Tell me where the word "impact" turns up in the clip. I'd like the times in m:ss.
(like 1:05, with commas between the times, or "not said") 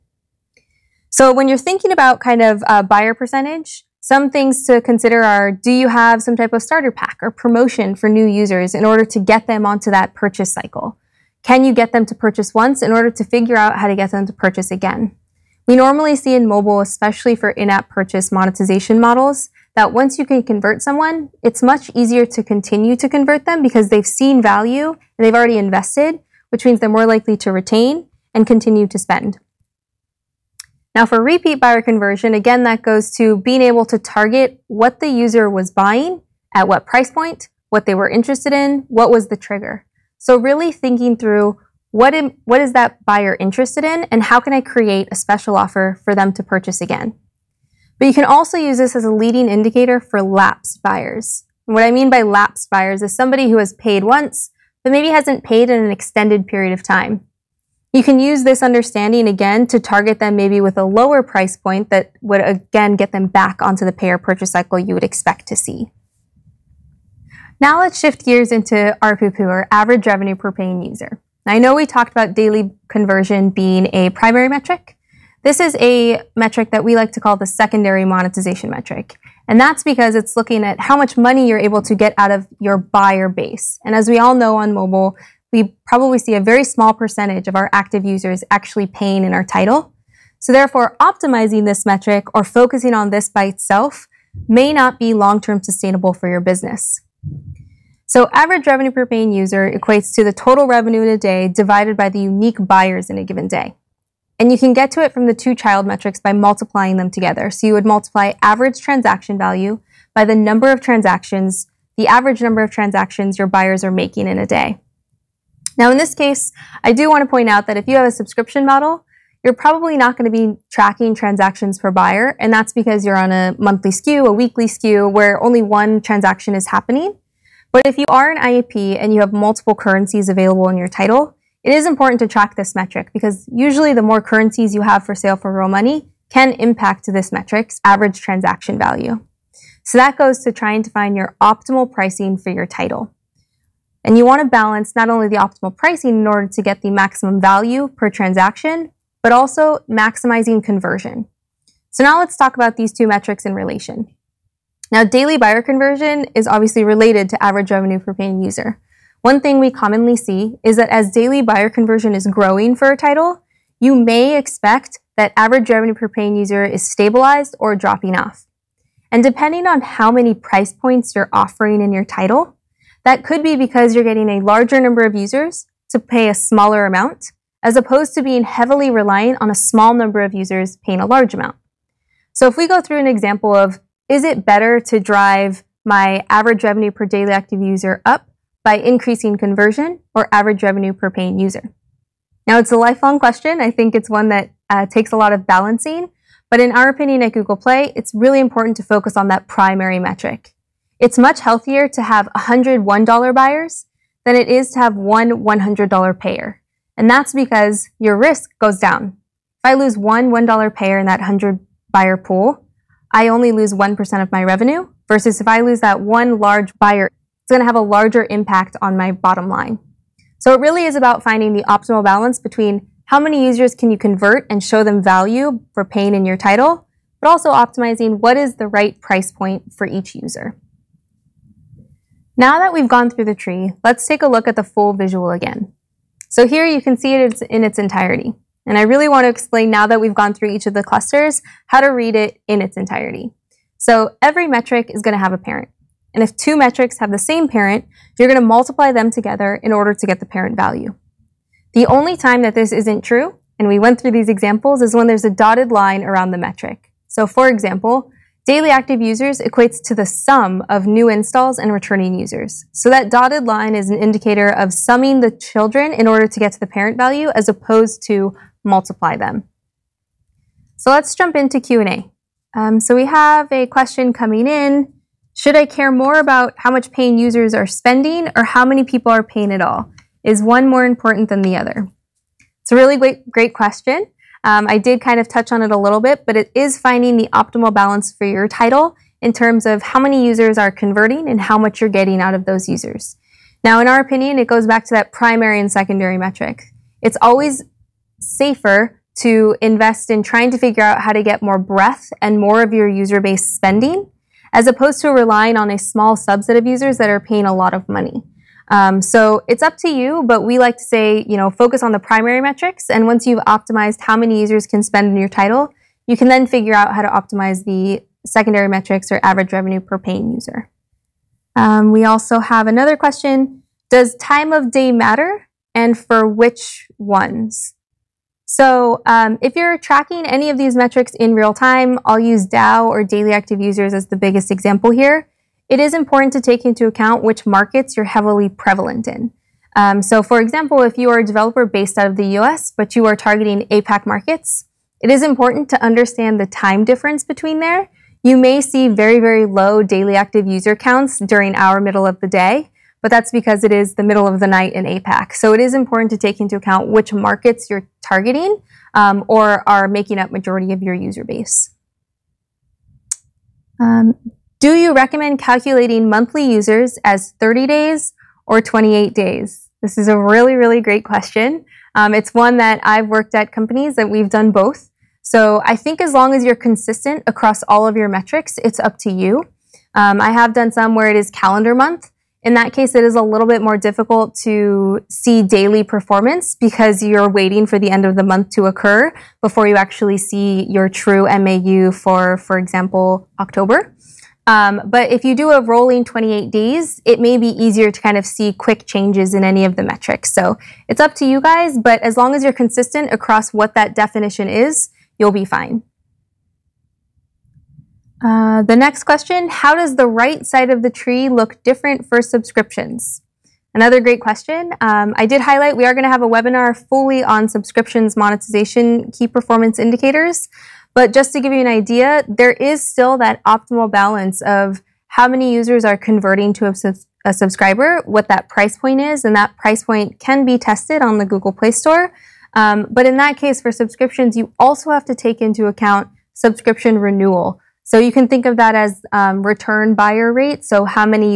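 2:16, 3:38.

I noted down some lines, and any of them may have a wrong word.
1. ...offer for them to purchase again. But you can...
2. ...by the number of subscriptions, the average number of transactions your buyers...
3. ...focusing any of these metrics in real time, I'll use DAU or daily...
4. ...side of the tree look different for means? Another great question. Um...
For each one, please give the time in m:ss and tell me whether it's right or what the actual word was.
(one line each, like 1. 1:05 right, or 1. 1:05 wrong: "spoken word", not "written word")
1. 0:45 right
2. 1:50 wrong: "transactions", not "subscriptions"
3. 5:29 wrong: "tracking", not "focusing"
4. 6:50 wrong: "subscriptions", not "means".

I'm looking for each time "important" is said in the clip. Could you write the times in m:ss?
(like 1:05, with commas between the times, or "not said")
2:11, 3:18, 4:40, 5:35, 5:45, 5:55.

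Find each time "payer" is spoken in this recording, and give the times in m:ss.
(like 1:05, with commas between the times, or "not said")
1:03, 3:26, 3:30.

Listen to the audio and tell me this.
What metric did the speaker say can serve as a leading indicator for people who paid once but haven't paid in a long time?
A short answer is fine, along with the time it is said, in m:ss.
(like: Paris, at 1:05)
Repeat buyer conversion, at 0:31.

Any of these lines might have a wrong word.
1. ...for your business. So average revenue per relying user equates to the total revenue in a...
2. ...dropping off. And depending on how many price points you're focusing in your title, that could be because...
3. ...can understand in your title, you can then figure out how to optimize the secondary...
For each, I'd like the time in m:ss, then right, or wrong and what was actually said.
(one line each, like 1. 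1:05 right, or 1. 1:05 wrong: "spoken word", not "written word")
1. 1:36 wrong: "paying", not "relying"
2. 2:47 wrong: "offering", not "focusing"
3. 5:14 wrong: "spend", not "understand".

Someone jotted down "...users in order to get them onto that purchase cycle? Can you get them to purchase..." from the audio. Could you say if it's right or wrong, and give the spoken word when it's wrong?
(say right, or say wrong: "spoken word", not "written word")
right.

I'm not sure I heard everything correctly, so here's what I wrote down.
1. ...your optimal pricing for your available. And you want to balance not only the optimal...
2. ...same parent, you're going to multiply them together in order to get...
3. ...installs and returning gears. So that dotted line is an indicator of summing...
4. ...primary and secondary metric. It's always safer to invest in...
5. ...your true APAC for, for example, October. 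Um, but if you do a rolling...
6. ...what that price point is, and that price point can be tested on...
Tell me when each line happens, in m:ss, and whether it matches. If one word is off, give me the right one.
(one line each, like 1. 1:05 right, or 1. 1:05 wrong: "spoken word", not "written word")
1. 2:21 wrong: "title", not "available"
2. 4:07 right
3. 4:21 wrong: "users", not "gears"
4. 4:55 right
5. 6:30 wrong: "MAU", not "APAC"
6. 7:08 right.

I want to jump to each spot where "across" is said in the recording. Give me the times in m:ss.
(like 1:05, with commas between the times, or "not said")
6:17, 6:43.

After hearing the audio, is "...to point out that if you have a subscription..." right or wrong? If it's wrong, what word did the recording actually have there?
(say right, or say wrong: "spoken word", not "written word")
right.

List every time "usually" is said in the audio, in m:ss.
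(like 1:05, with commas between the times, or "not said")
2:13.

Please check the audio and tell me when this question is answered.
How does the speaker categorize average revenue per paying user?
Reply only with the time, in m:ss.
1:17.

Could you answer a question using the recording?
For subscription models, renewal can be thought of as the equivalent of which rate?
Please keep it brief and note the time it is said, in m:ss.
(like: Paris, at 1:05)
Return buyer rate, at 7:19.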